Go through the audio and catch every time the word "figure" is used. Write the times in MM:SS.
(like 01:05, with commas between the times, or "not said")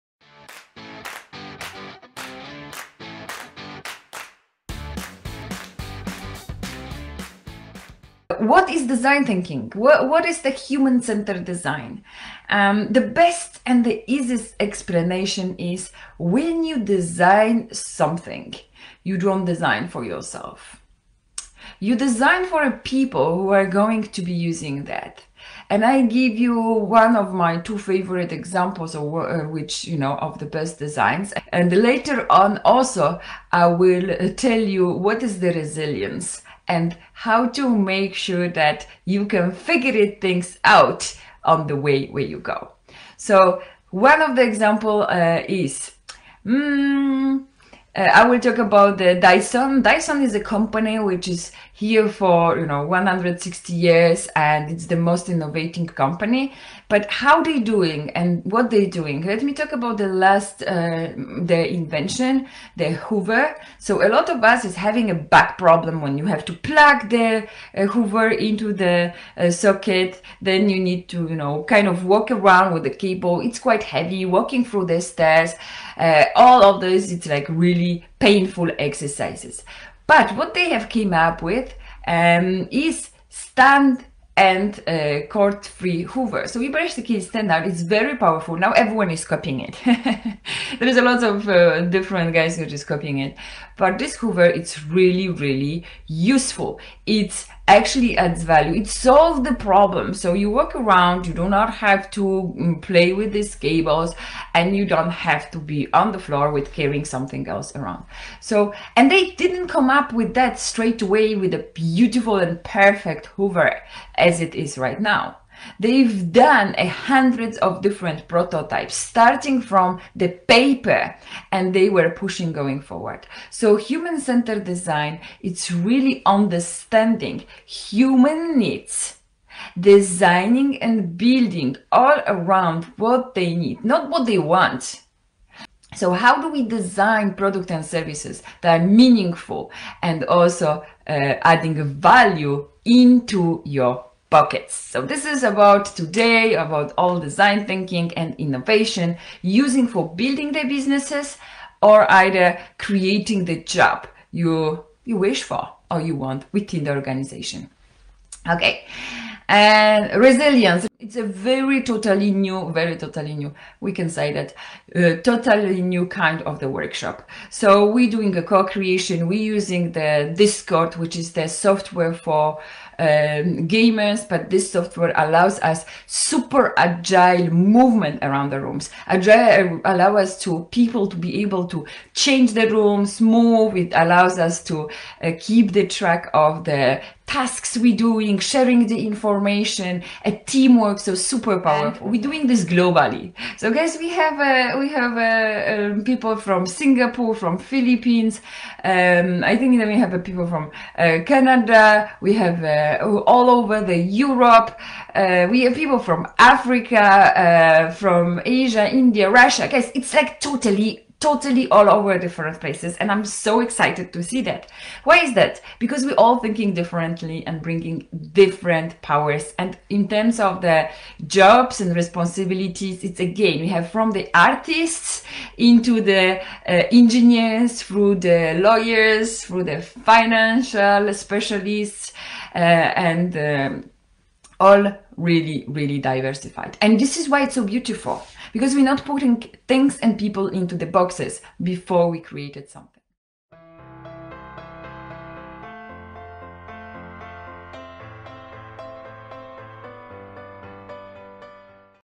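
00:39.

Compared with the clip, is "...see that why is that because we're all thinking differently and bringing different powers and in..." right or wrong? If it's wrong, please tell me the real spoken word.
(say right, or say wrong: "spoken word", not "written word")
right.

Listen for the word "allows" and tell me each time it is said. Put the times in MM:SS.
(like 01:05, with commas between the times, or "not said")
02:55, 02:59, 03:03.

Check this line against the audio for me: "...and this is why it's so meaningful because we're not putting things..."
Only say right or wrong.
wrong.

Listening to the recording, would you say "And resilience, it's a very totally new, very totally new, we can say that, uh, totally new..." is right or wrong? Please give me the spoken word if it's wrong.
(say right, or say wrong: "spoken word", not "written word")
right.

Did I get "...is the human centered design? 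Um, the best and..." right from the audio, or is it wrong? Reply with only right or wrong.
right.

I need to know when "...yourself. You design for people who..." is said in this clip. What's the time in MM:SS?
00:20.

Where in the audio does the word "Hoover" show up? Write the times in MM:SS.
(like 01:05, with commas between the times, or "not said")
01:03, 01:07, 01:26, 01:34, 01:53.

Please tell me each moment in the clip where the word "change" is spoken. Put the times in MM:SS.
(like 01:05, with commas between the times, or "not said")
03:02.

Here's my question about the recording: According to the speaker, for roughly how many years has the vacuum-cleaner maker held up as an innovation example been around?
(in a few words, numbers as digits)
160 years.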